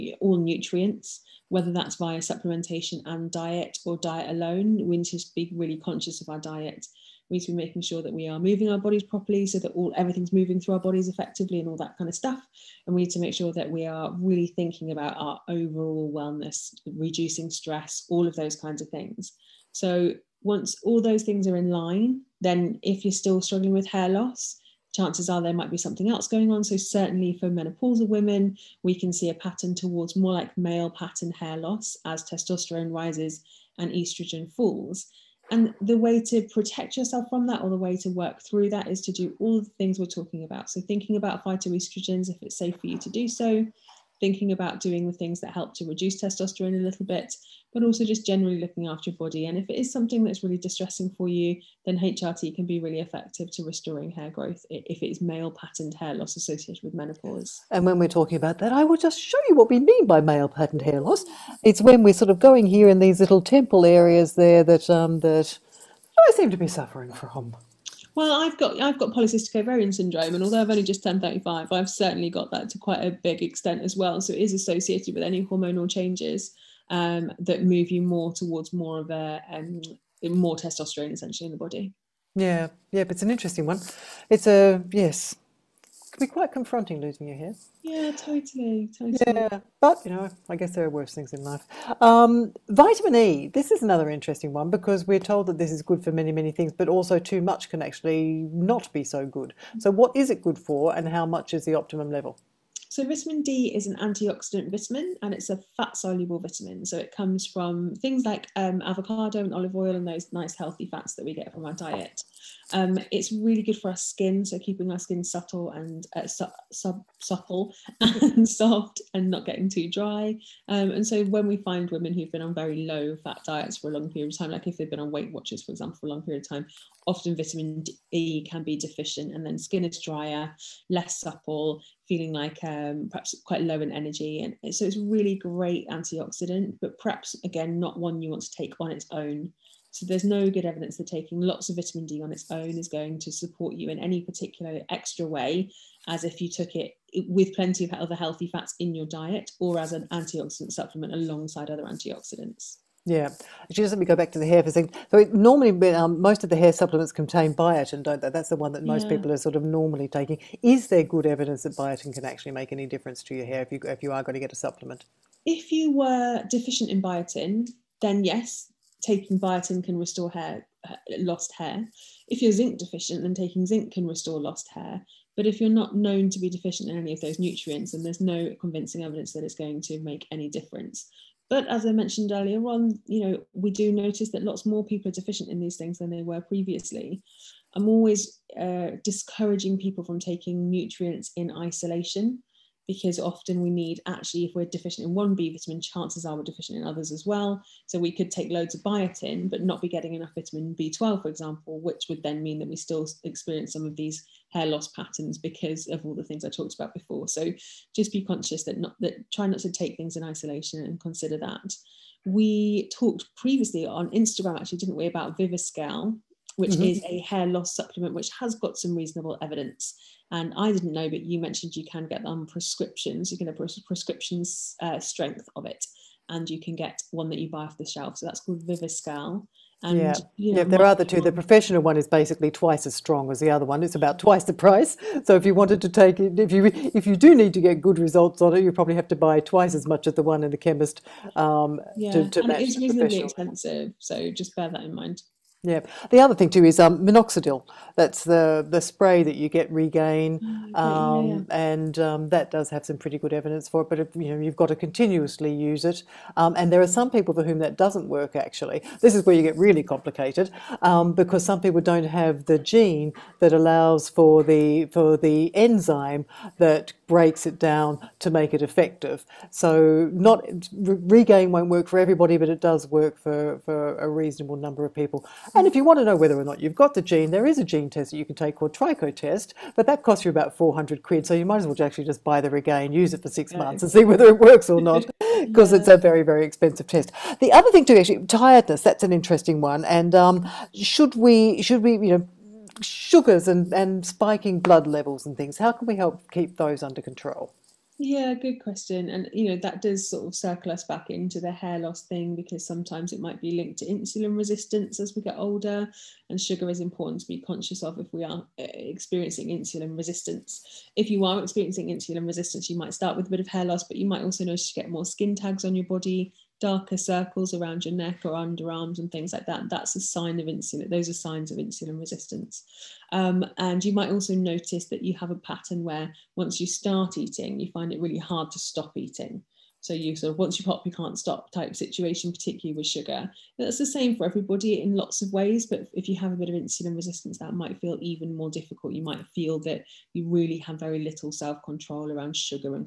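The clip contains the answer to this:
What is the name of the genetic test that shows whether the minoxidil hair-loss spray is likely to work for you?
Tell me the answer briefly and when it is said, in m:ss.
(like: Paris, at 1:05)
TrichoTest, at 4:38.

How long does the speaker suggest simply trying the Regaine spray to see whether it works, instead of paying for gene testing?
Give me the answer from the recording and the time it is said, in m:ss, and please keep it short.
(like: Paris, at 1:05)
6 months, at 4:43.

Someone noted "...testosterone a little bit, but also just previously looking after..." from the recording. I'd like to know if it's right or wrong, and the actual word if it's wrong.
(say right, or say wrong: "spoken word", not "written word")
wrong: "generally", not "previously".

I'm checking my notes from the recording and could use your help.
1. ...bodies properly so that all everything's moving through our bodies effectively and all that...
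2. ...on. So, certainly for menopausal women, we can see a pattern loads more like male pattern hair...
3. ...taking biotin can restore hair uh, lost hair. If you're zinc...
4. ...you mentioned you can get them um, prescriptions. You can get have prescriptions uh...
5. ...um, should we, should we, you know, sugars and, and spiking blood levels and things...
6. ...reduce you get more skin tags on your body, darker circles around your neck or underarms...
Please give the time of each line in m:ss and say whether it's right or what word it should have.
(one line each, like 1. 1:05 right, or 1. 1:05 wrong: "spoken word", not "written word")
1. 0:08 right
2. 0:26 wrong: "towards", not "loads"
3. 2:48 right
4. 3:41 right
5. 4:50 right
6. 5:14 wrong: "notice", not "reduce".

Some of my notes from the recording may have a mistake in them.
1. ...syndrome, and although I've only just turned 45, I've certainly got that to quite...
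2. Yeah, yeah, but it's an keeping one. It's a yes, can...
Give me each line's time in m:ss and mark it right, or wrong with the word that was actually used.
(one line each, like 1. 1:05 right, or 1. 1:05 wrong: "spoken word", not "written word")
1. 1:09 wrong: "35", not "45"
2. 1:22 wrong: "interesting", not "keeping".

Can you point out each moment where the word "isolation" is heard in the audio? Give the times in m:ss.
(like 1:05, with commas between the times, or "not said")
3:11, 3:30.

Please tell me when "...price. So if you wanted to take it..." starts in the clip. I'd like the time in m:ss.
3:54.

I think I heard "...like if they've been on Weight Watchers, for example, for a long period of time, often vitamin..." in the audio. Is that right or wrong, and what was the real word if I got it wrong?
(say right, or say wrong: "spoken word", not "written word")
right.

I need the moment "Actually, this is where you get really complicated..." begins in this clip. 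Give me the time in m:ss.
4:18.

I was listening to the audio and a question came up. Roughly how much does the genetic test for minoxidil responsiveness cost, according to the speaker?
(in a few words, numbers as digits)
£400.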